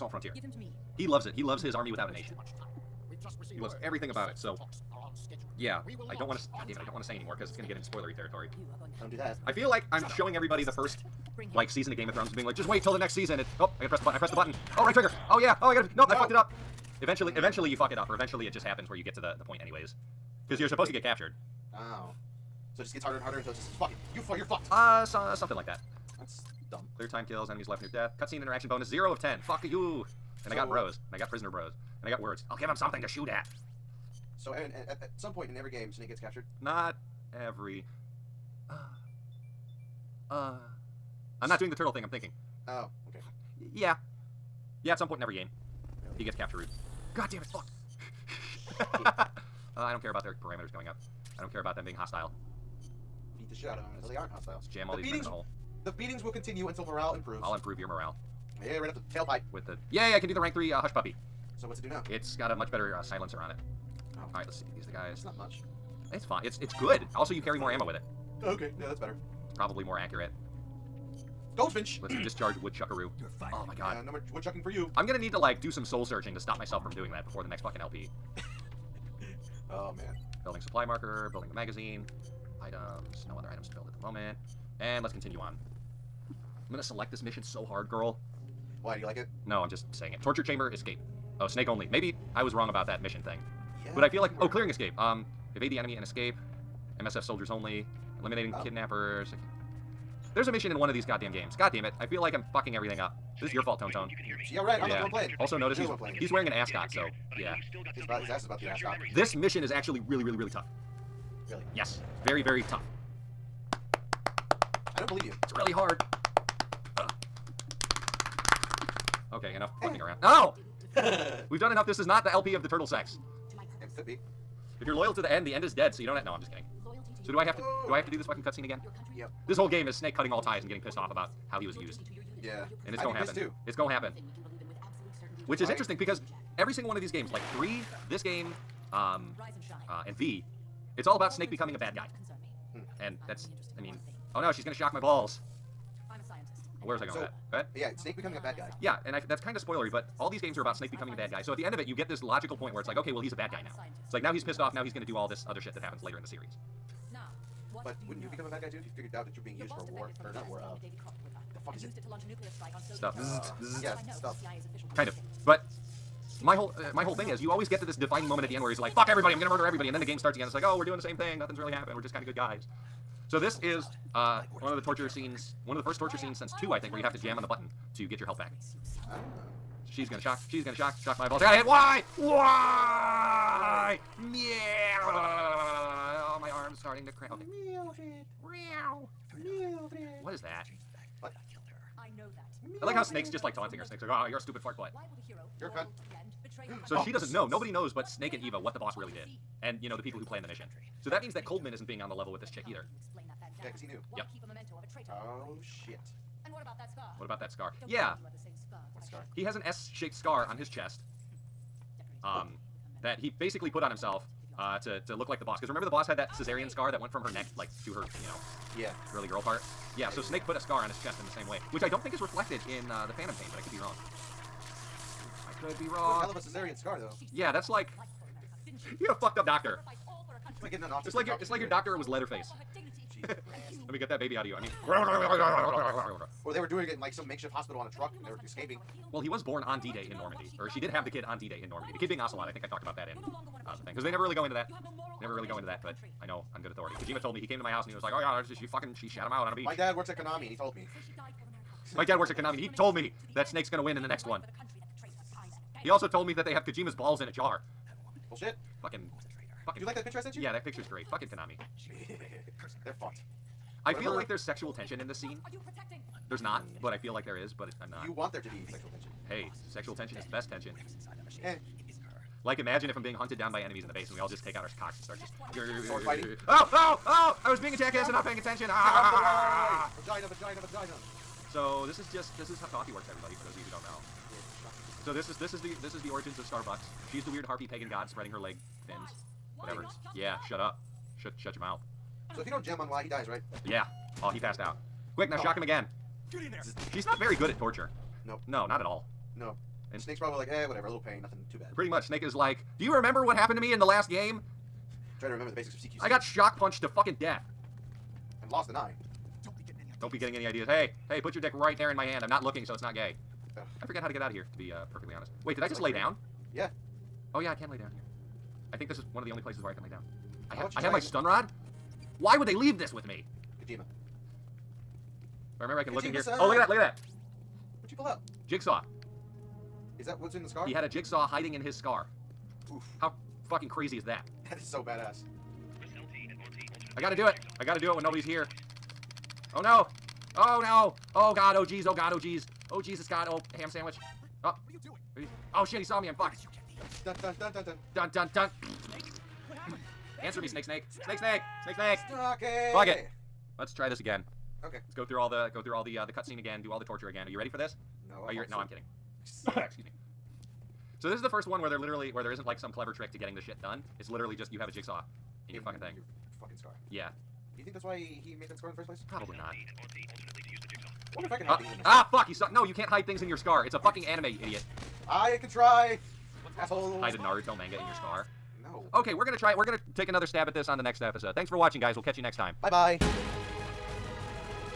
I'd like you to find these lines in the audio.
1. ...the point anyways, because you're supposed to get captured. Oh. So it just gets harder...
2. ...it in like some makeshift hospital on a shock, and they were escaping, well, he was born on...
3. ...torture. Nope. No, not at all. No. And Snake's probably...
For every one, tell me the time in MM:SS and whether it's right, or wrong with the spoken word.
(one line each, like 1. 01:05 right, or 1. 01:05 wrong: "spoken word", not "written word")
1. 00:19 right
2. 03:56 wrong: "truck", not "shock"
3. 04:57 right.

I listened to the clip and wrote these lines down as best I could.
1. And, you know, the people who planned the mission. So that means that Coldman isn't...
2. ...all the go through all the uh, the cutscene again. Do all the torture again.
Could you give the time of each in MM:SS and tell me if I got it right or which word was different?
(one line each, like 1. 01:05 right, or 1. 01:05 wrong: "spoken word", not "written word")
1. 03:19 right
2. 05:55 right.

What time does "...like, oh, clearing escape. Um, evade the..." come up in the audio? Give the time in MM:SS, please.
01:34.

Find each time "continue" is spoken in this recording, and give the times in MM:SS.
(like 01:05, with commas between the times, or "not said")
00:56, 01:25.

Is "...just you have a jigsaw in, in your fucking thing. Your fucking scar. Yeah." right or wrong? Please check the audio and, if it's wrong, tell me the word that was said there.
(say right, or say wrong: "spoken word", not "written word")
right.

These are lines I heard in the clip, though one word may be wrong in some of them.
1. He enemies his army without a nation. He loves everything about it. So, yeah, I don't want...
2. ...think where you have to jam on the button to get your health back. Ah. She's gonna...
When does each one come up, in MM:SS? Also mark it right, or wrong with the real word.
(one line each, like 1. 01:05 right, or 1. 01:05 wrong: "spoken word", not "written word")
1. 00:01 wrong: "loves", not "enemies"
2. 02:56 right.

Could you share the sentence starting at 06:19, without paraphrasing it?
We're gonna take another stab at this on the next episode.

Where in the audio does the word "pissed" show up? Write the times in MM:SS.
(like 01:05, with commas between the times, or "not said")
02:10, 02:34.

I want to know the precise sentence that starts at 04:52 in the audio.
So if you don't jam on why he dies, right?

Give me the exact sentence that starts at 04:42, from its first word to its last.
This is how coffee works, everybody, for those of you who don't know.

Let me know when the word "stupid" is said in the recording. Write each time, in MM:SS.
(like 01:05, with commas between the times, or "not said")
03:14.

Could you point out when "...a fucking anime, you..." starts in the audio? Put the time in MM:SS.
06:13.